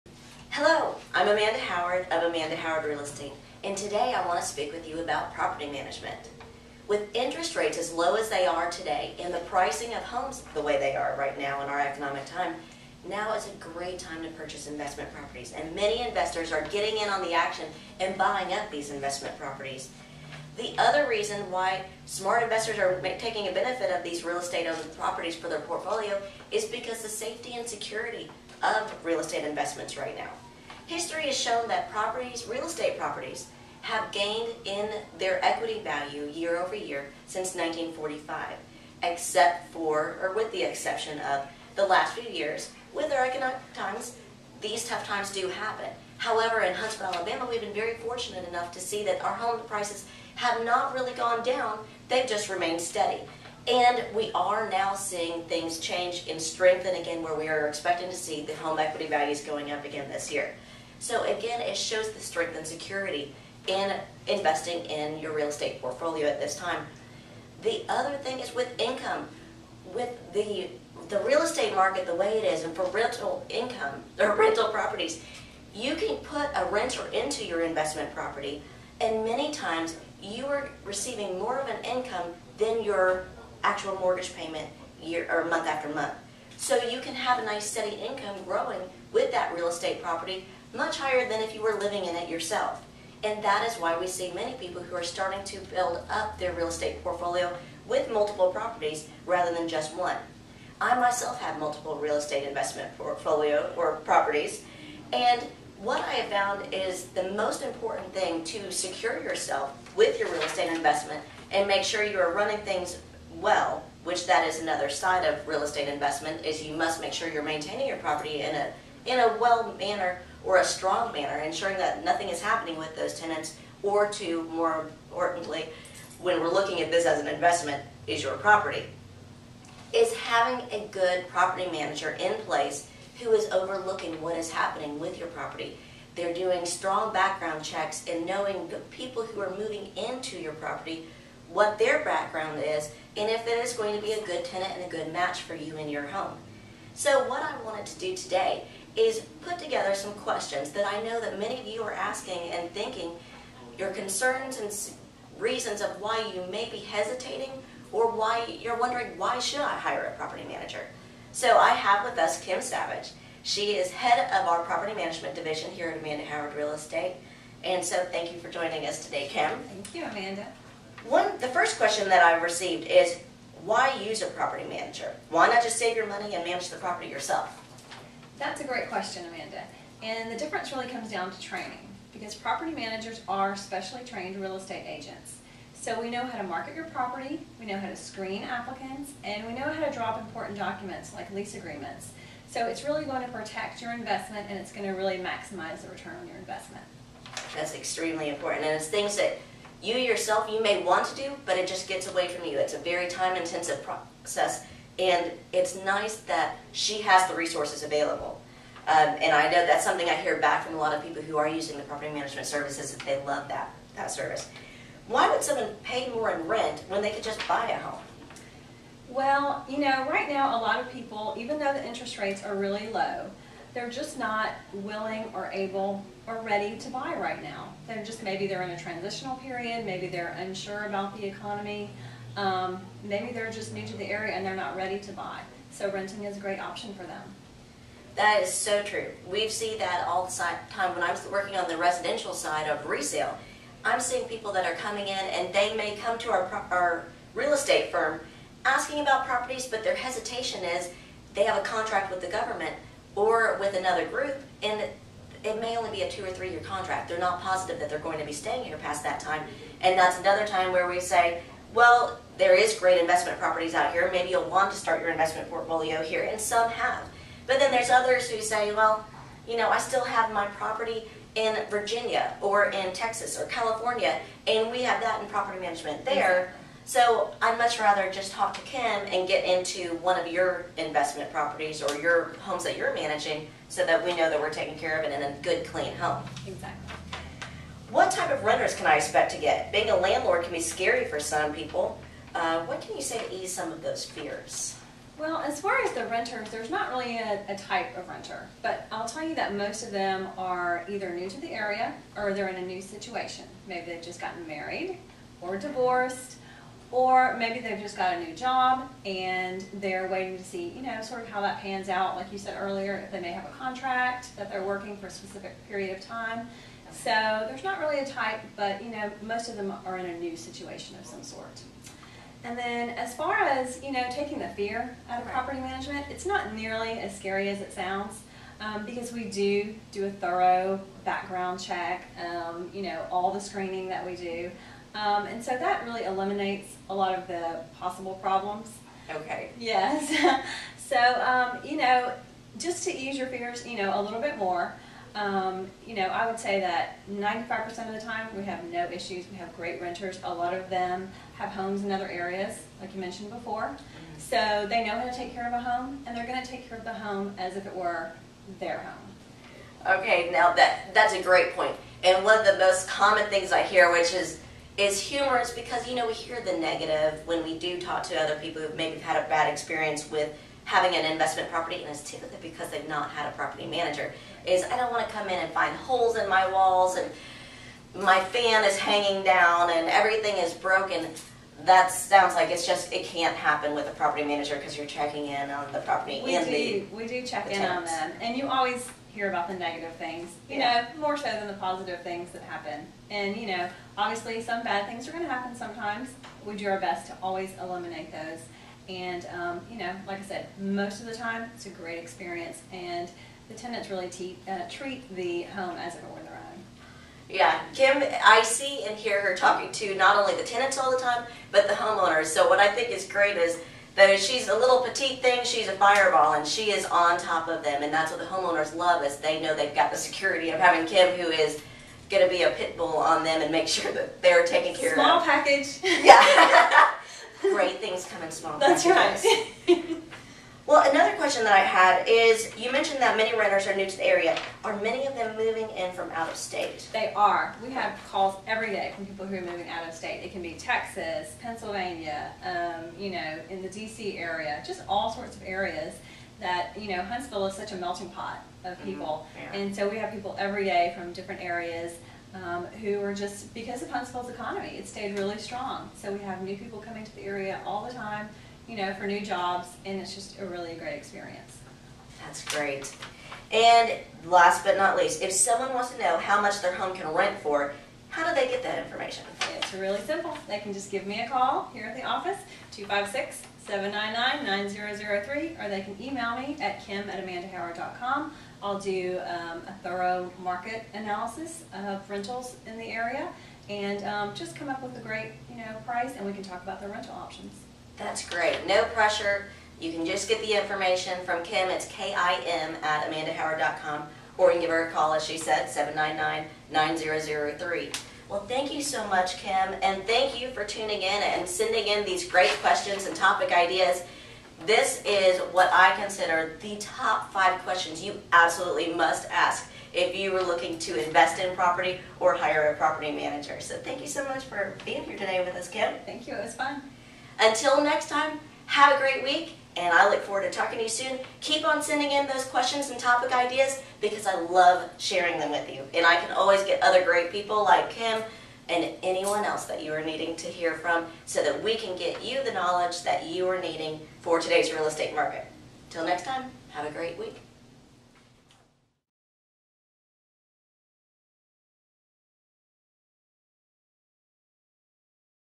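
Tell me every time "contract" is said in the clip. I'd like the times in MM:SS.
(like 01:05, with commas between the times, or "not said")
04:11, 04:16, 05:13.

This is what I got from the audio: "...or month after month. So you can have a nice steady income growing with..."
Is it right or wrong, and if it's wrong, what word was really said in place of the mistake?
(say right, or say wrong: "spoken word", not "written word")
right.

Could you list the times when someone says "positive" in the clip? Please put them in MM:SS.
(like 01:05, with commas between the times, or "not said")
04:17, 06:31.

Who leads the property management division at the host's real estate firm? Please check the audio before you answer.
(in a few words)
Kim Savage.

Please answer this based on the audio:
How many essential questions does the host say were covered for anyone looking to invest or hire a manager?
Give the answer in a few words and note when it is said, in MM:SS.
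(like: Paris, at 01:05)
5, at 08:27.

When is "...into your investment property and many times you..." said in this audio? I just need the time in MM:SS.
01:17.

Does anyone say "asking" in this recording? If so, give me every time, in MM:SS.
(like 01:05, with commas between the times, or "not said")
02:31, 04:08.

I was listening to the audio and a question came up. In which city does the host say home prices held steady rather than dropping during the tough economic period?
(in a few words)
Huntsville, Alabama.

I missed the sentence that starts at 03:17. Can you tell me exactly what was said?
That's extremely important and it's things that you yourself you may want to do but it just gets away from you.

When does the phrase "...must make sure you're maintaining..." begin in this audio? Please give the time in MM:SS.
01:56.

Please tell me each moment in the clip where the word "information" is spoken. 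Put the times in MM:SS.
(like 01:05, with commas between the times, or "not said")
07:48, 08:10.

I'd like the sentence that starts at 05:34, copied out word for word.
Um, and so that really eliminates a lot of the possible problems.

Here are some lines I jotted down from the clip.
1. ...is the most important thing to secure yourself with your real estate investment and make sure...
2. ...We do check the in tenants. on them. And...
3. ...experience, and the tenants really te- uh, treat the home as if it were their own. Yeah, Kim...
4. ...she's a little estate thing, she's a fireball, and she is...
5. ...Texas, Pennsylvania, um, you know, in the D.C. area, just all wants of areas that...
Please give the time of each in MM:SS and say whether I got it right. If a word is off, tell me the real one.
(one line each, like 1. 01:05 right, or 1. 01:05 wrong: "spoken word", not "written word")
1. 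01:46 right
2. 06:26 right
3. 06:41 right
4. 06:54 wrong: "petite", not "estate"
5. 07:20 wrong: "sorts", not "wants".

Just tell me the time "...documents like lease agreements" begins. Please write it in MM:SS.
03:10.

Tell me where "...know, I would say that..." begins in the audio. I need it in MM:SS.
05:45.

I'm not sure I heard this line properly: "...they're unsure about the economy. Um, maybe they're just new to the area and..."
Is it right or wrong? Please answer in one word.
right.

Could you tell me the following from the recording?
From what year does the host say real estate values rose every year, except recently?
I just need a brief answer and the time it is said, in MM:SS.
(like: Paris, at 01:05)
1945, at 00:37.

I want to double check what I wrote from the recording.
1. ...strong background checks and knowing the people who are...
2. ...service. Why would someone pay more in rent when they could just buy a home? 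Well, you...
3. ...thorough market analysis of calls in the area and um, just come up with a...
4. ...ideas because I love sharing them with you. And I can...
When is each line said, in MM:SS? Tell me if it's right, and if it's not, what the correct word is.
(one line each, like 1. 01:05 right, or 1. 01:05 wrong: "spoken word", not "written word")
1. 02:16 right
2. 03:34 right
3. 07:59 wrong: "rentals", not "calls"
4. 08:43 right.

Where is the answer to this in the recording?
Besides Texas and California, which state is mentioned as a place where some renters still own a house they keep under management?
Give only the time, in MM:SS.
04:31.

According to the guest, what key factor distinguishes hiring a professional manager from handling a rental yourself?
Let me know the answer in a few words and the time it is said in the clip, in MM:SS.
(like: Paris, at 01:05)
Training, at 03:01.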